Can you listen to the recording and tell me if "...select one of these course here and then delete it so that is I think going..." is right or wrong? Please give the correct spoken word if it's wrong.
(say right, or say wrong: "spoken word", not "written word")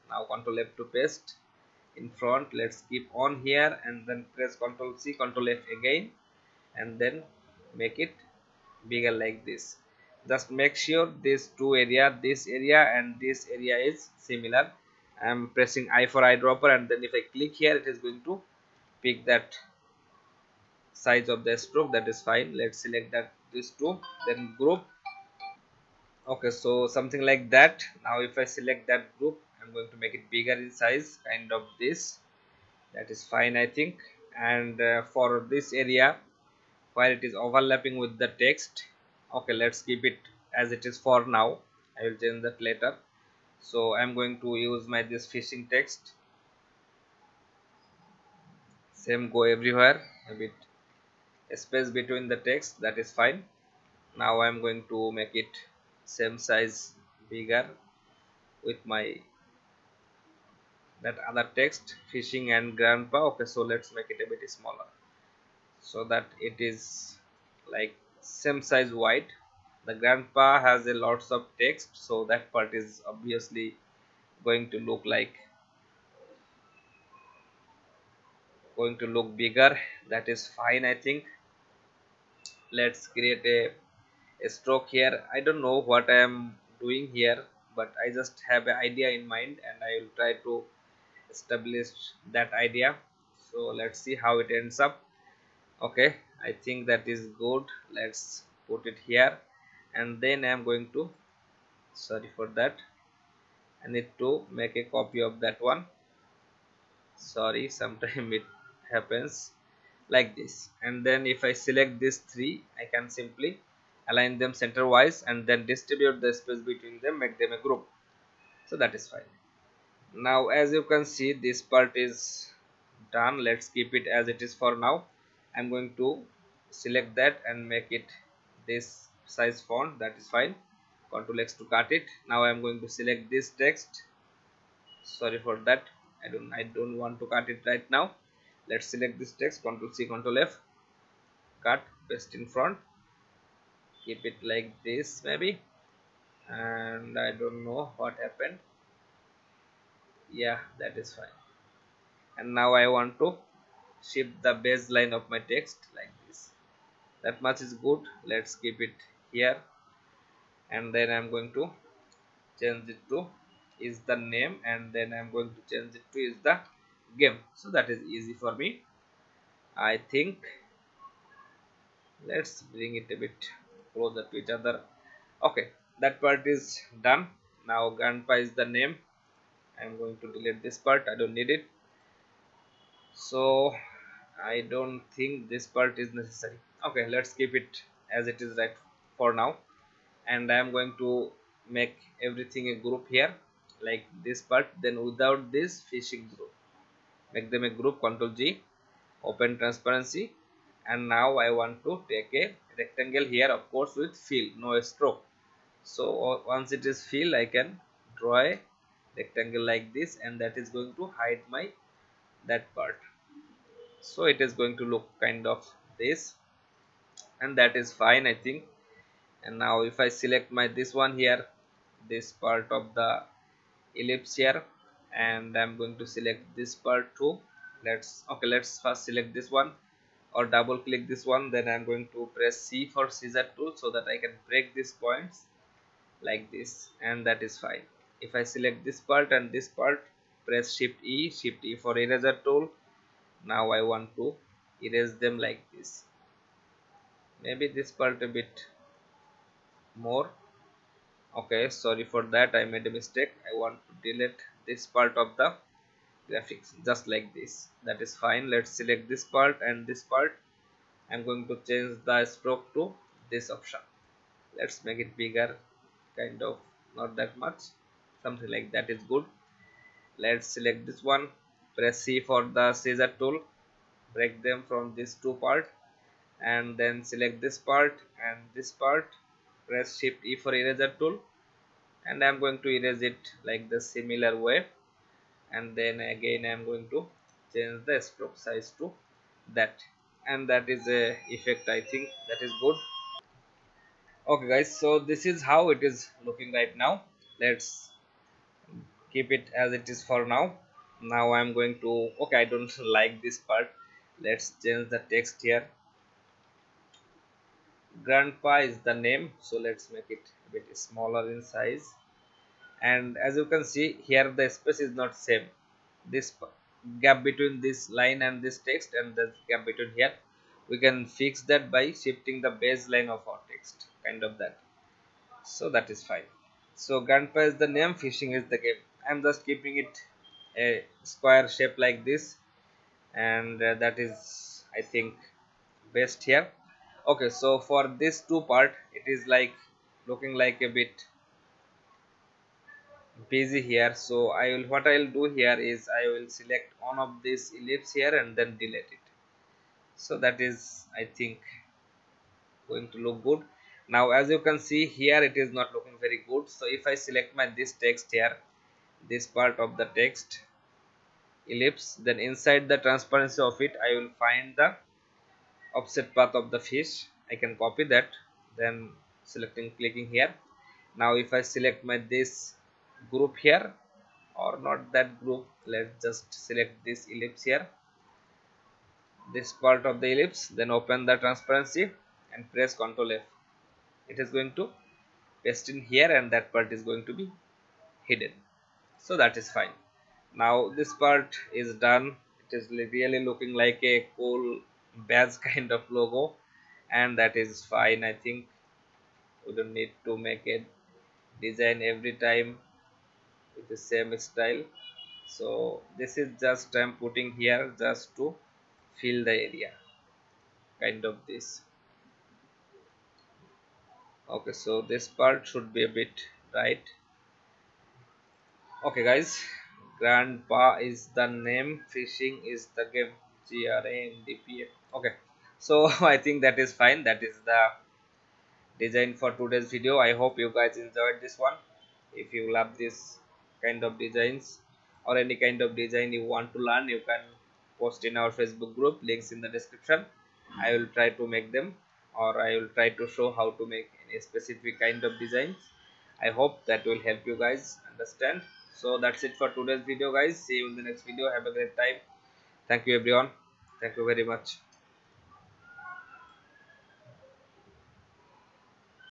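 wrong: "ellipse", not "course".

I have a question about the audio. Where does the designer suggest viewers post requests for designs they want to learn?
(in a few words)
Facebook group.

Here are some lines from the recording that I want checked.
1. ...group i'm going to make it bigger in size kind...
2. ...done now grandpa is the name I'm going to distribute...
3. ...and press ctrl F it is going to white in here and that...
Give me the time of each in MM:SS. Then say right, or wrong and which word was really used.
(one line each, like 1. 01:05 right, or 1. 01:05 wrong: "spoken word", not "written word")
1. 00:29 right
2. 02:57 wrong: "delete", not "distribute"
3. 06:22 wrong: "paste", not "white".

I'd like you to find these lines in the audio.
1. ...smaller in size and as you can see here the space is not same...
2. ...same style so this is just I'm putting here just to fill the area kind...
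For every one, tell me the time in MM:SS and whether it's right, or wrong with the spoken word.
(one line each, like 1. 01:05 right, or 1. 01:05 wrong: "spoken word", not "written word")
1. 05:10 right
2. 06:43 right.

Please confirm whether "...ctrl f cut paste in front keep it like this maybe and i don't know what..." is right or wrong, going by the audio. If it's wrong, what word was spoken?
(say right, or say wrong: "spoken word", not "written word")
right.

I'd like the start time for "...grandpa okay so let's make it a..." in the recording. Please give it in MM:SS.
01:02.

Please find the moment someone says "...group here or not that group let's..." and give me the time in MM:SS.
06:13.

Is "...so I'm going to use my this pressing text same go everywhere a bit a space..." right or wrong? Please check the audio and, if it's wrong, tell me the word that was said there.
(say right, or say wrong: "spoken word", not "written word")
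wrong: "fishing", not "pressing".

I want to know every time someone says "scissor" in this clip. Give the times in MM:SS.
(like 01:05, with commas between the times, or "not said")
03:53, 04:32.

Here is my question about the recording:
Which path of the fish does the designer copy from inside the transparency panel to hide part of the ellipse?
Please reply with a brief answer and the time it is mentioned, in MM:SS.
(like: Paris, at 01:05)
Offset path, at 06:05.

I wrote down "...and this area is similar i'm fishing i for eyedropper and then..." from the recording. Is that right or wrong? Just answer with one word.
wrong.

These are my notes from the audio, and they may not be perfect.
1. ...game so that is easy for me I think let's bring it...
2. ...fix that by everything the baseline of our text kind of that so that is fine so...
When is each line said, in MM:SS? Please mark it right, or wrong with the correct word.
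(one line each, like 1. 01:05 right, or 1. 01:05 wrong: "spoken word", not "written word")
1. 02:47 right
2. 05:21 wrong: "shifting", not "everything".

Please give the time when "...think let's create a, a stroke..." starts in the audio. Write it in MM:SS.
01:20.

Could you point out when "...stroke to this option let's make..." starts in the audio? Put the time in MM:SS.
04:22.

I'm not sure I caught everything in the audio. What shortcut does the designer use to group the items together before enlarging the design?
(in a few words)
Control G.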